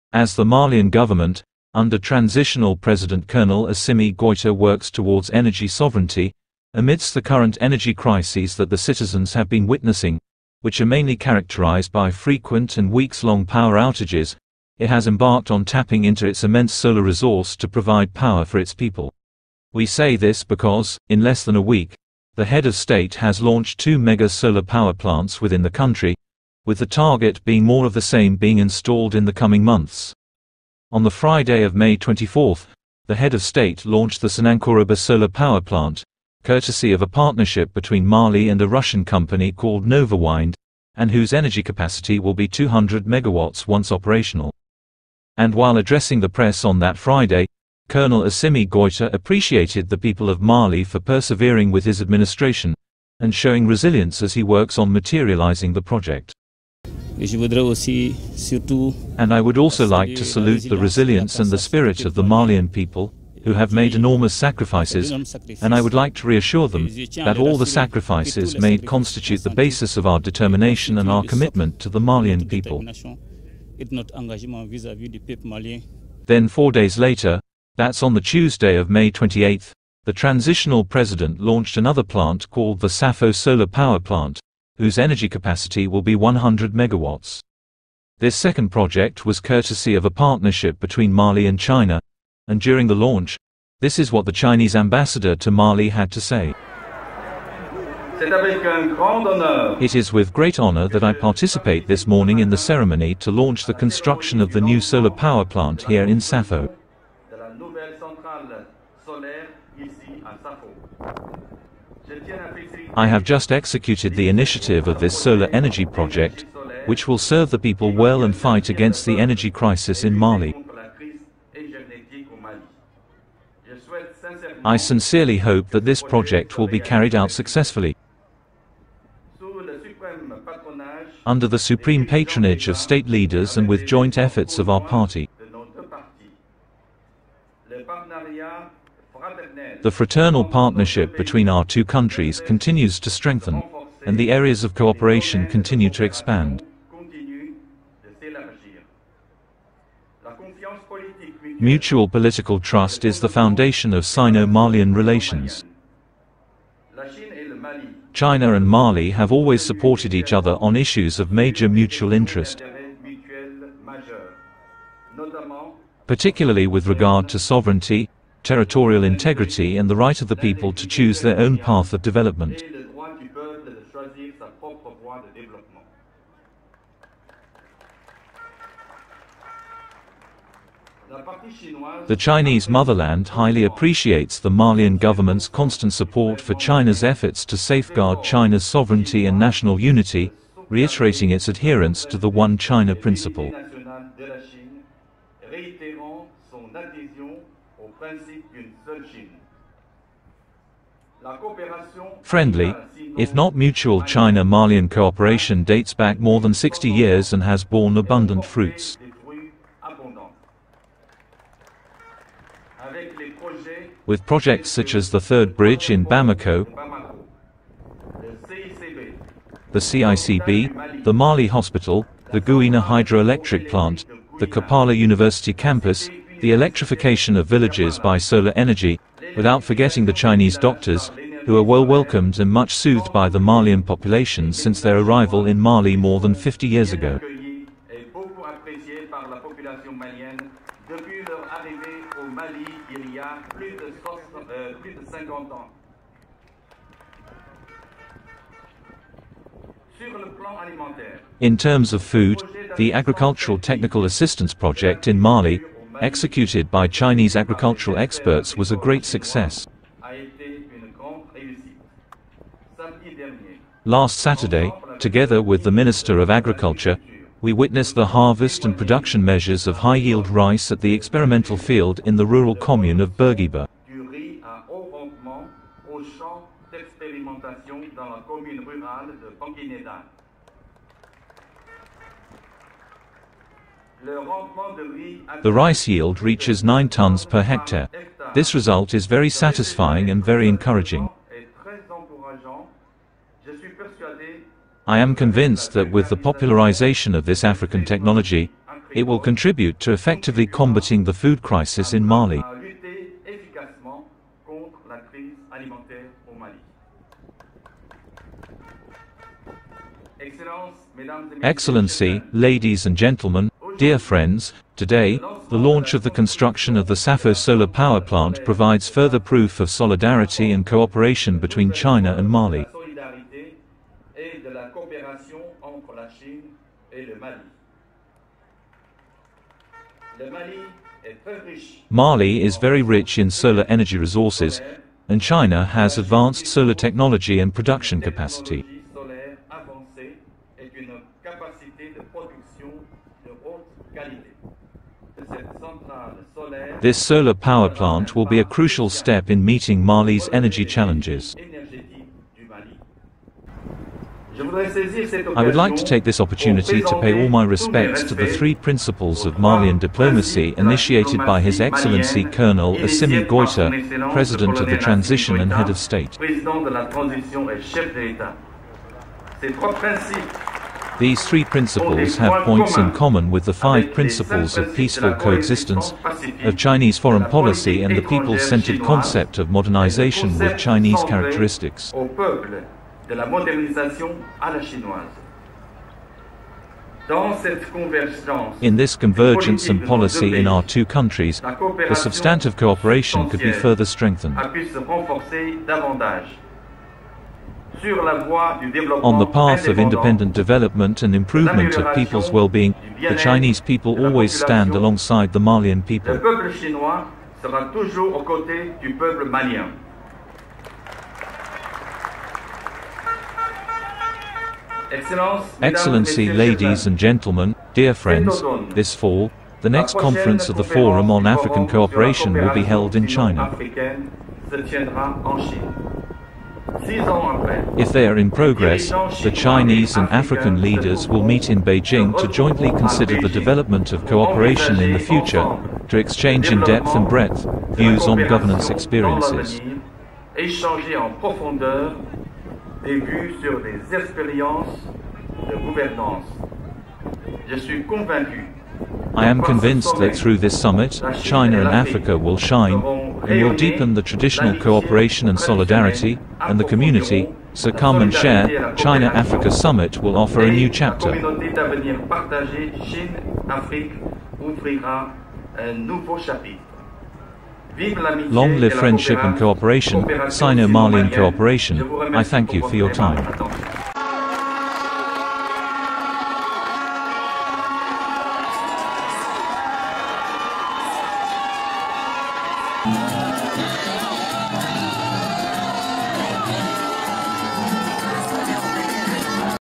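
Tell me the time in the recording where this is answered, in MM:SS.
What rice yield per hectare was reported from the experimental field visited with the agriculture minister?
04:46.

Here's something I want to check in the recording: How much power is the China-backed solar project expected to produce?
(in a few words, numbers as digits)
100 megawatts.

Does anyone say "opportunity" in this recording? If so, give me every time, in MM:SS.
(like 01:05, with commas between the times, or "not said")
05:56.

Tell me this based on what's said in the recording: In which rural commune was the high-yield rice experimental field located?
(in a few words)
Bergiba.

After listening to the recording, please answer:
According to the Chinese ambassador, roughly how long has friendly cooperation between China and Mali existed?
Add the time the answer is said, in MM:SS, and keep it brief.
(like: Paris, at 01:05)
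more than 60 years, at 03:26.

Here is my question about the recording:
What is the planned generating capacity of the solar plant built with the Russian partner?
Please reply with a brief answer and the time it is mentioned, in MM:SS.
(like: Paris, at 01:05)
200 megawatts, at 00:42.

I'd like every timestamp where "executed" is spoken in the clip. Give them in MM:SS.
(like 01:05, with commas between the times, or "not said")
01:53, 04:16.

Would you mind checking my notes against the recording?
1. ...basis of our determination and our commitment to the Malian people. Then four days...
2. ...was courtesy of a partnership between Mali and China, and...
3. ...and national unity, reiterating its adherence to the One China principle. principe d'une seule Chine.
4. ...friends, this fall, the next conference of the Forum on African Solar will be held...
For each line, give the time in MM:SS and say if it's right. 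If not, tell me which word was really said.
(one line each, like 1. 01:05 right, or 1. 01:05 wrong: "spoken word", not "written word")
1. 01:09 right
2. 01:29 right
3. 03:09 right
4. 06:57 wrong: "Cooperation", not "Solar".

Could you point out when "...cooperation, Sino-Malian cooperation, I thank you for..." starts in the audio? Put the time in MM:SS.
07:49.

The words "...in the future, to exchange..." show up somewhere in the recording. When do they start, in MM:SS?
07:14.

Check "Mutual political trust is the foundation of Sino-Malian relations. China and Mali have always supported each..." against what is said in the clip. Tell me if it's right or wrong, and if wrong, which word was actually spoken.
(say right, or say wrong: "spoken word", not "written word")
right.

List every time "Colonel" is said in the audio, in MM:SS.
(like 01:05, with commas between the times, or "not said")
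00:03, 00:47, 06:02.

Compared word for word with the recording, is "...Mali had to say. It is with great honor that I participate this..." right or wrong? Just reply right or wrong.
right.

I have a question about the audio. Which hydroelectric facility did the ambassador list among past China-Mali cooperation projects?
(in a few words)
Gouina Hydroelectric Plant.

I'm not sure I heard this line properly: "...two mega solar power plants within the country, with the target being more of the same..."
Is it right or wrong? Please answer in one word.
right.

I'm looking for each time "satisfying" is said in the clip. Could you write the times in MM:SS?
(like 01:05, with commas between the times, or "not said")
04:49.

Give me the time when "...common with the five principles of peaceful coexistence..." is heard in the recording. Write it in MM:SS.
06:12.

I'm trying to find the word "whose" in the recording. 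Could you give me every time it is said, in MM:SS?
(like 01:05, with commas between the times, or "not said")
00:41, 01:24.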